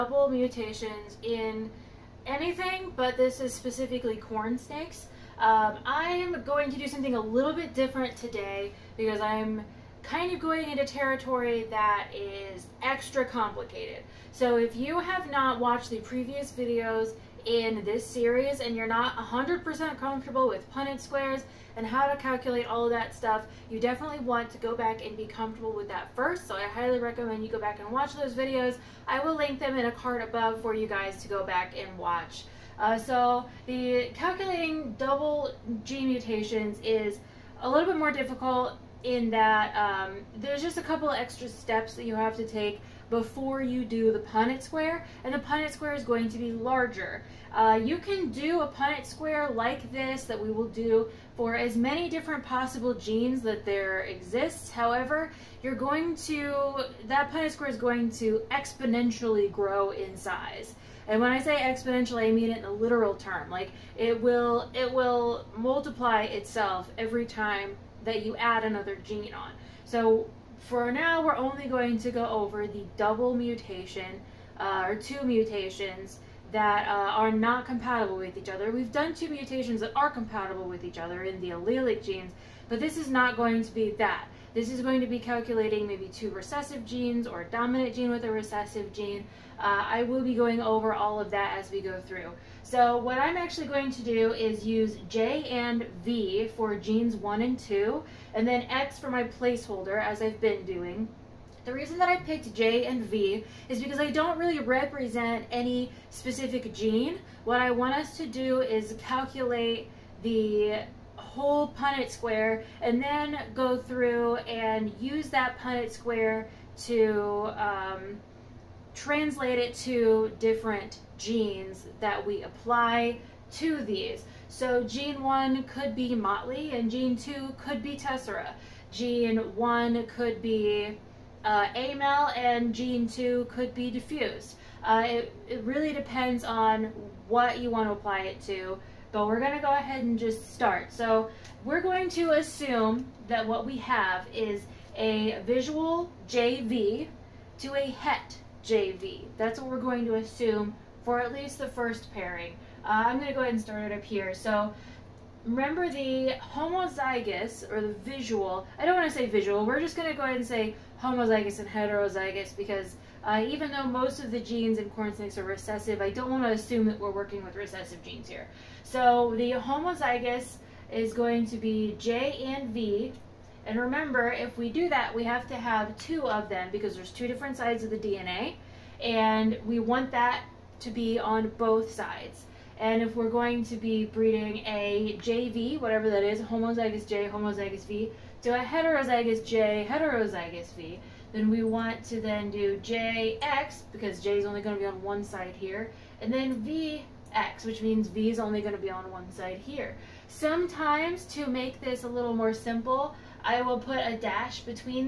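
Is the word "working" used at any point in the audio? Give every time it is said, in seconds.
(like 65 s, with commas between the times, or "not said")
167 s.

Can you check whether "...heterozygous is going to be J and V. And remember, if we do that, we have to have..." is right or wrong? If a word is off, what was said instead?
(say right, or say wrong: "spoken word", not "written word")
wrong: "homozygous", not "heterozygous".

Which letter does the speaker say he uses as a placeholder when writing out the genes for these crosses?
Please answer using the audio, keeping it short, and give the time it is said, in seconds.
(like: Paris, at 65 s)
X, at 98 s.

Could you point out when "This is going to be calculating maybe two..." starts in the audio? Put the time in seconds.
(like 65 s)
84 s.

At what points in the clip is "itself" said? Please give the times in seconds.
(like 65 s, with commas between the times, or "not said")
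66 s.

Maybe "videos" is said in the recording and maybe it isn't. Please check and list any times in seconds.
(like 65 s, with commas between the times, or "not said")
16 s, 28 s.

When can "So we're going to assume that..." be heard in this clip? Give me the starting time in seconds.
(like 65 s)
140 s.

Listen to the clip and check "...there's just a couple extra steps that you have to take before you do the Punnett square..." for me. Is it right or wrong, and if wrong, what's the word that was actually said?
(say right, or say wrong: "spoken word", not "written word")
right.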